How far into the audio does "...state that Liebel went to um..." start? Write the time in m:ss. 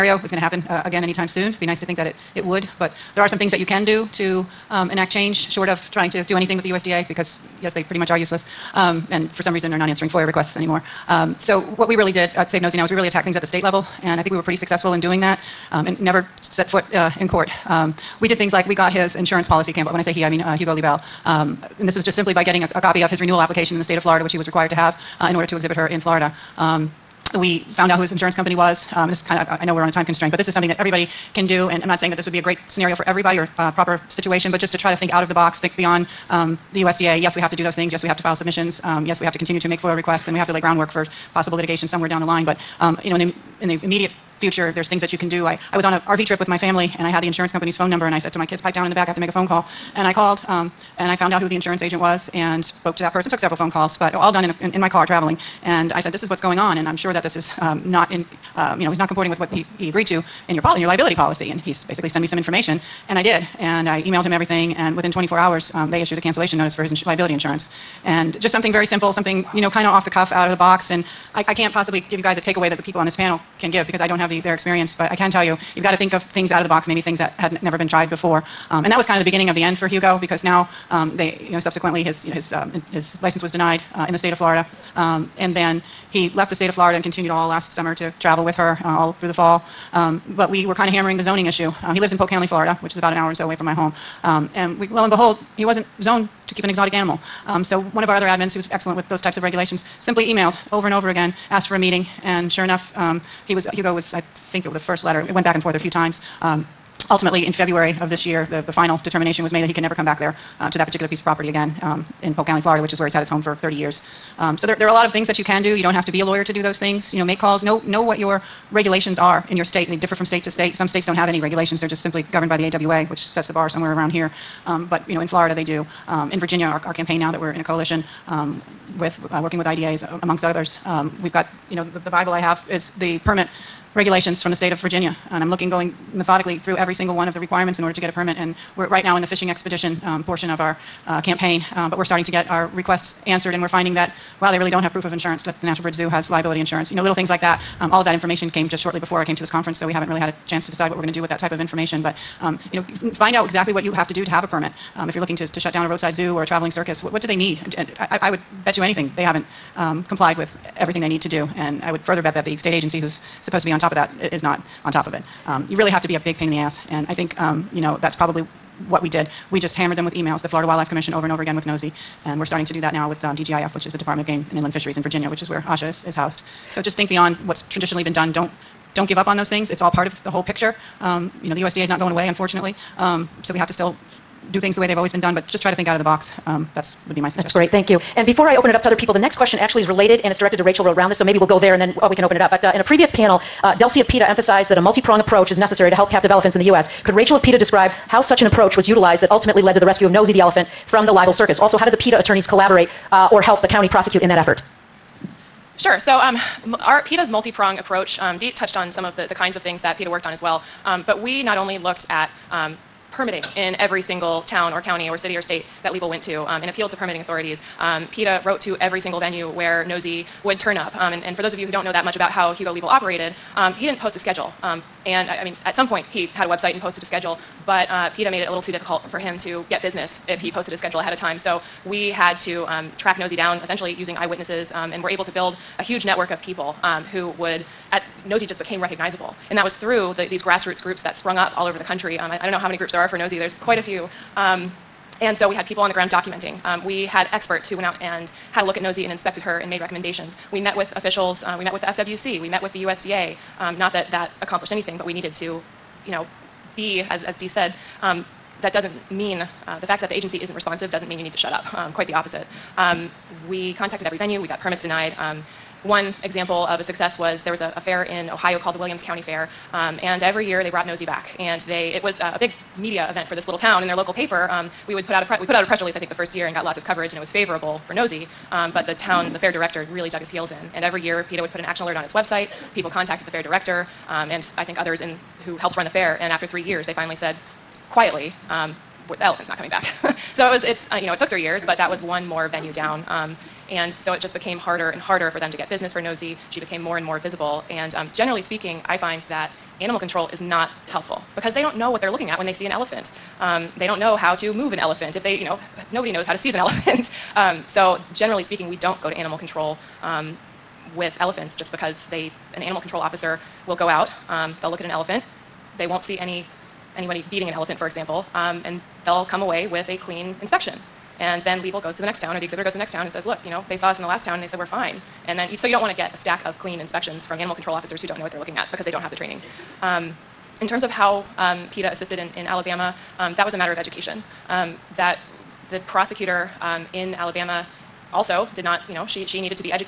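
3:35.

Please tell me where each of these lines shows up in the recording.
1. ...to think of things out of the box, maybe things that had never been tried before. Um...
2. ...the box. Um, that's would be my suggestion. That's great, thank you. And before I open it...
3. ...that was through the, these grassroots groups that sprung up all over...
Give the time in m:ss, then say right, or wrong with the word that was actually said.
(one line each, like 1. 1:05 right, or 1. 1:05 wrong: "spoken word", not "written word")
1. 1:15 right
2. 3:05 right
3. 3:59 right.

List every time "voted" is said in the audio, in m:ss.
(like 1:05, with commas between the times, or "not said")
not said.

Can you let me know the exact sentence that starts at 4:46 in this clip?
And after three years, they finally said, quietly, um, the elephant's not coming back.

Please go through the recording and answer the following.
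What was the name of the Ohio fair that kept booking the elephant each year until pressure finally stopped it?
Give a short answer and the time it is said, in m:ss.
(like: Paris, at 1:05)
Williams County Fair, at 4:28.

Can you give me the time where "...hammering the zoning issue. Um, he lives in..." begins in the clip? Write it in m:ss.
1:30.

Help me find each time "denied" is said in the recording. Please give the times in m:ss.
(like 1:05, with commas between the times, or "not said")
1:23, 4:24.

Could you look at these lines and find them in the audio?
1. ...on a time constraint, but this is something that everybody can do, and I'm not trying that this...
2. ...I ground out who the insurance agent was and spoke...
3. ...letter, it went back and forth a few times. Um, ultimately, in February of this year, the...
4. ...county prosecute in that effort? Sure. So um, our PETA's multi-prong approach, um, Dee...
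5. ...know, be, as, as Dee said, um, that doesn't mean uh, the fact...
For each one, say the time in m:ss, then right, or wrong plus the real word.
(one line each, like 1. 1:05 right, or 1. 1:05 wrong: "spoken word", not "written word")
1. 0:29 wrong: "saying", not "trying"
2. 0:51 wrong: "found", not "ground"
3. 1:45 right
4. 3:23 right
5. 4:16 right.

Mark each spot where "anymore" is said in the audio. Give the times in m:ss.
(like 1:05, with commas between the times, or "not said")
0:10.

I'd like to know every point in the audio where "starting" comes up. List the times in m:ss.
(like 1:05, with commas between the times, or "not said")
2:22, 2:52.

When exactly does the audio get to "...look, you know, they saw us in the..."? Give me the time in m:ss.
5:23.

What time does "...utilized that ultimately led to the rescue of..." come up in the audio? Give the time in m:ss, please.
3:18.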